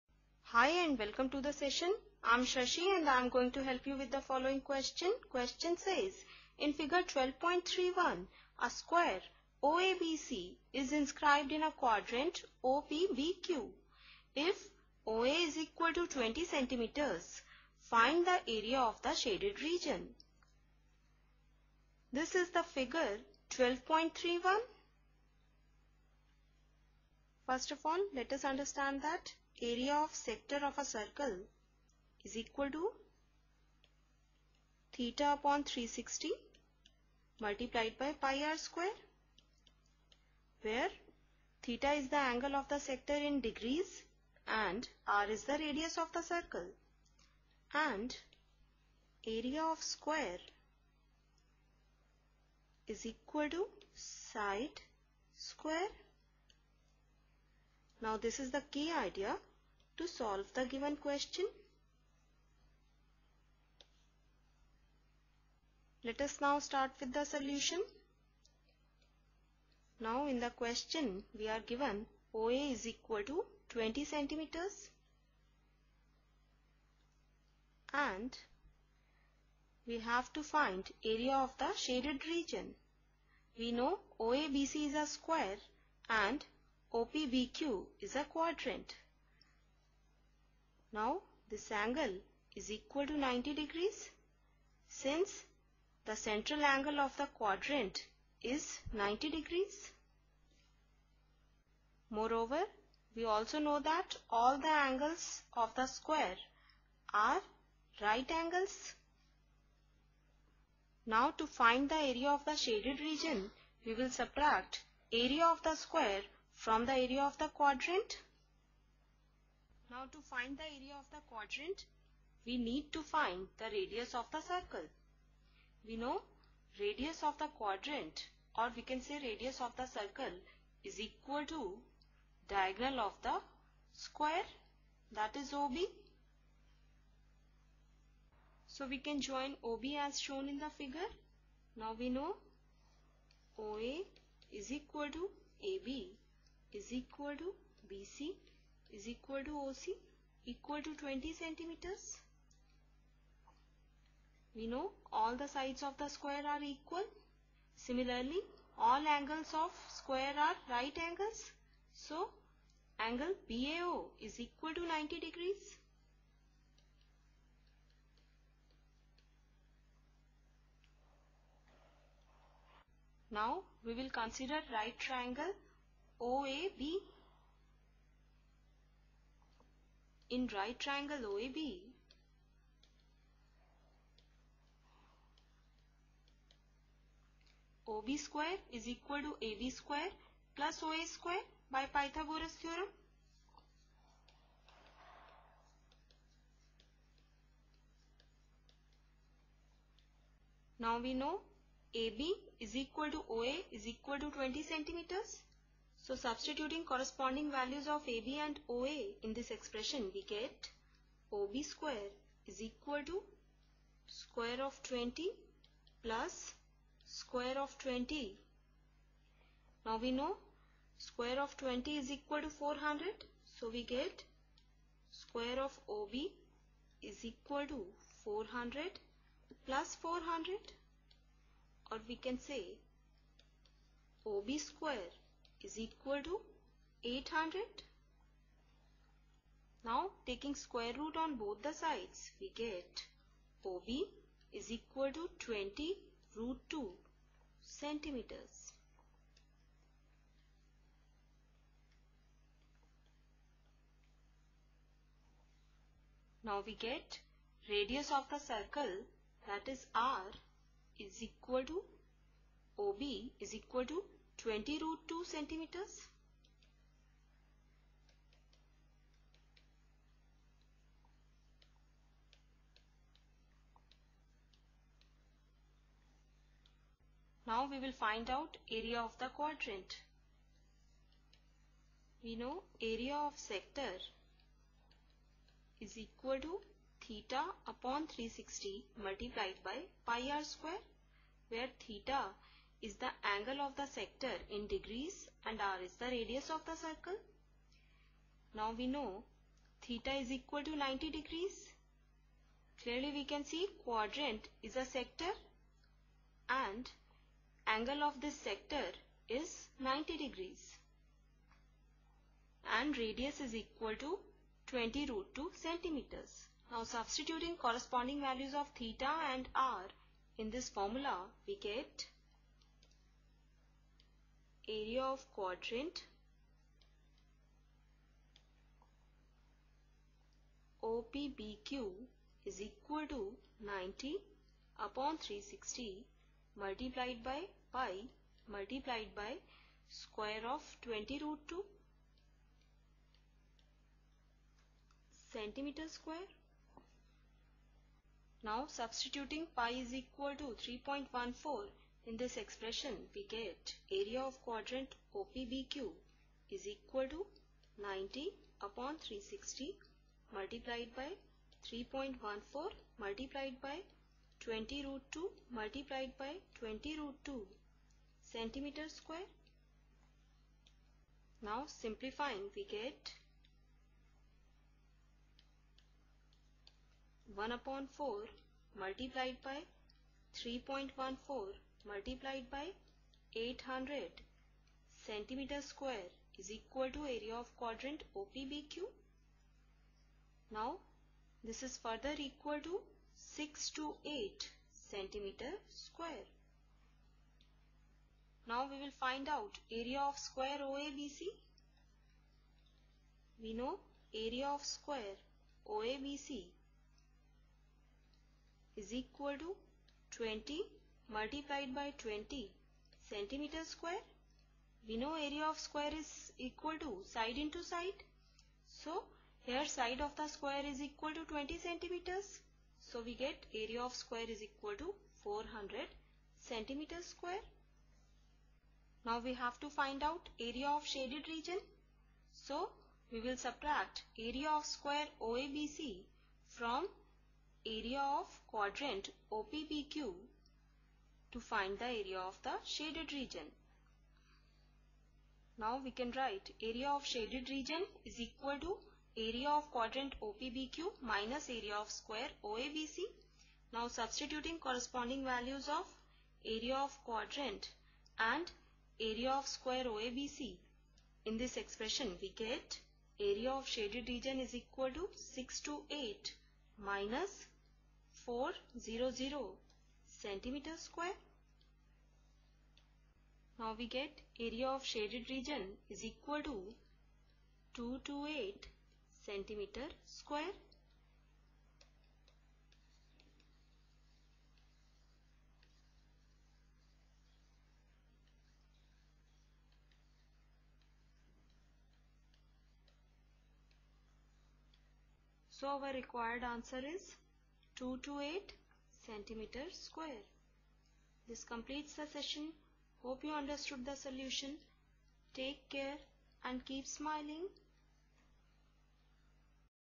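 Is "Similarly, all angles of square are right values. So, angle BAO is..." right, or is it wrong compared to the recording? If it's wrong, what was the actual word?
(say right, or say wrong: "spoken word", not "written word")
wrong: "angles", not "values".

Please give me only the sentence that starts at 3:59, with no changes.
Now taking square root on both the sides, we get OB is equal to 20 root 2 centimeters.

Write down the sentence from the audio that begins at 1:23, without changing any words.
We know OABC is a square and OPBQ is a quadrant.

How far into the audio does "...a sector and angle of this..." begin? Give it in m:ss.
5:04.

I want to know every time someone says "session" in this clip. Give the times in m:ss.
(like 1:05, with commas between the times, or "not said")
0:01, 8:22.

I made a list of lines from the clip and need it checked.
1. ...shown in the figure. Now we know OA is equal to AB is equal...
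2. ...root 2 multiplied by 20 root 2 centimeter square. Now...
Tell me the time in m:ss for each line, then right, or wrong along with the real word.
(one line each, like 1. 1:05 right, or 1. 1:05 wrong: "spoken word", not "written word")
1. 2:20 right
2. 6:04 right.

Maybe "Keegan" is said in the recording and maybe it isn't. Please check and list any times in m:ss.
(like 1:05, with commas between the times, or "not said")
not said.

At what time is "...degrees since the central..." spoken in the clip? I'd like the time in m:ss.
1:33.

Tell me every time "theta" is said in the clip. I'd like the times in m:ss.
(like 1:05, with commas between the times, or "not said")
0:34, 0:41, 4:47, 4:51, 4:59, 5:18.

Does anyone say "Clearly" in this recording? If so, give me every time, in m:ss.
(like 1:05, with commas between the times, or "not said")
5:02.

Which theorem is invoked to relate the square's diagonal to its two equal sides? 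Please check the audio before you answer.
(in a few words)
Pythagoras theorem.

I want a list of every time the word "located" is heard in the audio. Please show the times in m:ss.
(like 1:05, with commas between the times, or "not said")
not said.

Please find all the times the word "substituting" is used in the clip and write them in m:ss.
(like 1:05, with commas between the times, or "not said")
3:26, 5:16, 5:48, 7:33.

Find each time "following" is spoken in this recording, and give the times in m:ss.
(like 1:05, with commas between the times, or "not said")
0:04.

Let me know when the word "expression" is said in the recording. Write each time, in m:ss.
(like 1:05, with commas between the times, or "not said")
3:29, 5:52, 7:41.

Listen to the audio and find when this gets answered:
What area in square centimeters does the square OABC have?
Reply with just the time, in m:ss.
7:05.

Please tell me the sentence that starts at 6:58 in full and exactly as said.
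So here side of the square is equal to 20 centimeters.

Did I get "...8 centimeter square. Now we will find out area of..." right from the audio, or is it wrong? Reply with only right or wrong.
right.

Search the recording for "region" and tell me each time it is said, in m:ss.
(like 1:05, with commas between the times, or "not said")
0:19, 1:22, 1:52, 7:11, 7:23, 7:27, 7:44, 7:55.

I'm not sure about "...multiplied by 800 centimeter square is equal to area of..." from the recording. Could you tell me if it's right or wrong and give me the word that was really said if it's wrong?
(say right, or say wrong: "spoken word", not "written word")
right.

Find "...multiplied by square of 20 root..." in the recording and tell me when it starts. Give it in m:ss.
5:38.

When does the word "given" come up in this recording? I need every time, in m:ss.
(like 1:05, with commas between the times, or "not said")
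1:00, 1:11.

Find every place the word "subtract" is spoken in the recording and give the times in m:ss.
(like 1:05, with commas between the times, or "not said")
1:54, 7:13.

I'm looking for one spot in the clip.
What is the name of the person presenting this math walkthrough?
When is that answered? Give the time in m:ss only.
0:02.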